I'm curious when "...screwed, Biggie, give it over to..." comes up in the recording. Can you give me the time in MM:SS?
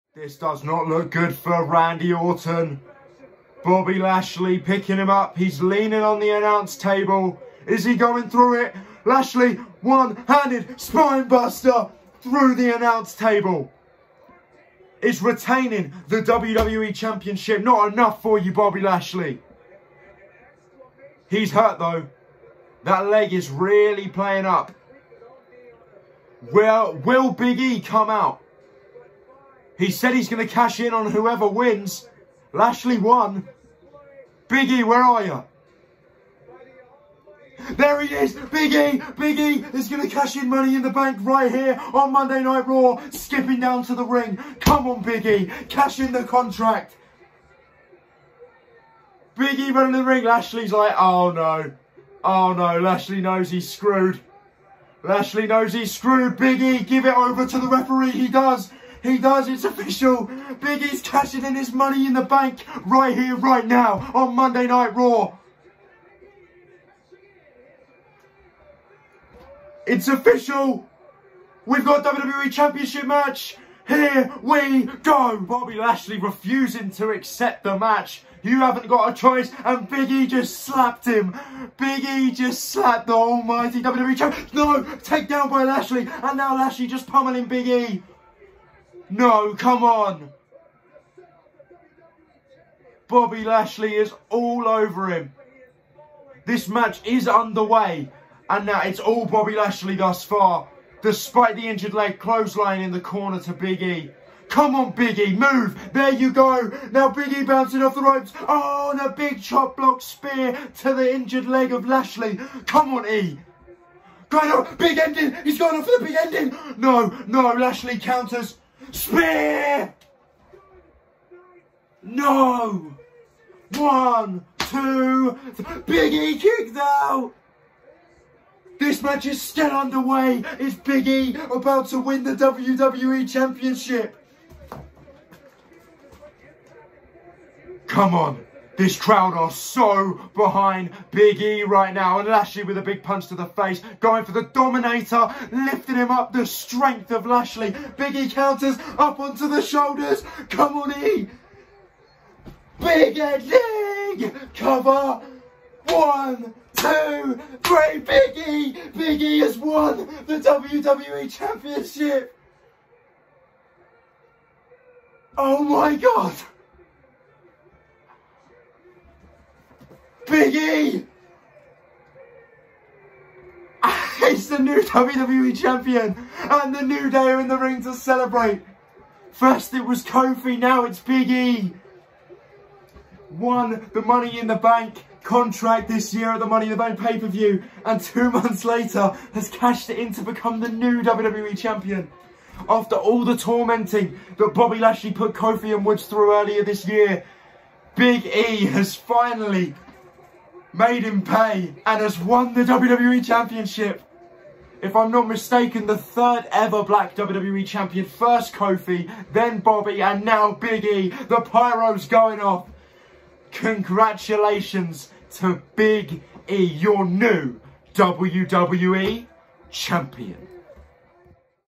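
00:55.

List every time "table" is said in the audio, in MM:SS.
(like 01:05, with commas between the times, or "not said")
00:06, 00:13.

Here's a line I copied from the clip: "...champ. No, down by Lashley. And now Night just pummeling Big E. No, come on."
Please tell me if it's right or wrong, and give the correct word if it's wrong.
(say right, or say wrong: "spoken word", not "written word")
wrong: "Lashley", not "Night".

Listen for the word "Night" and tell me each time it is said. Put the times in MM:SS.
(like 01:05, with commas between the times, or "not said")
00:42, 01:04.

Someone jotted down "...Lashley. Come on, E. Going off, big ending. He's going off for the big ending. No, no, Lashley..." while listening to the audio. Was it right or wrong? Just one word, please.
right.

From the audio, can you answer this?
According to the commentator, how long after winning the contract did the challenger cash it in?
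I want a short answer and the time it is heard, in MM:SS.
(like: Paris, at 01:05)
2 months, at 03:07.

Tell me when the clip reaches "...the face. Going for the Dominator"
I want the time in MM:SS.
02:23.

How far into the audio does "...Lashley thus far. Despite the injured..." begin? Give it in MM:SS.
01:39.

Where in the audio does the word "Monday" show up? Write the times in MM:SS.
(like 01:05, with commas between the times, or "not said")
00:42, 01:04.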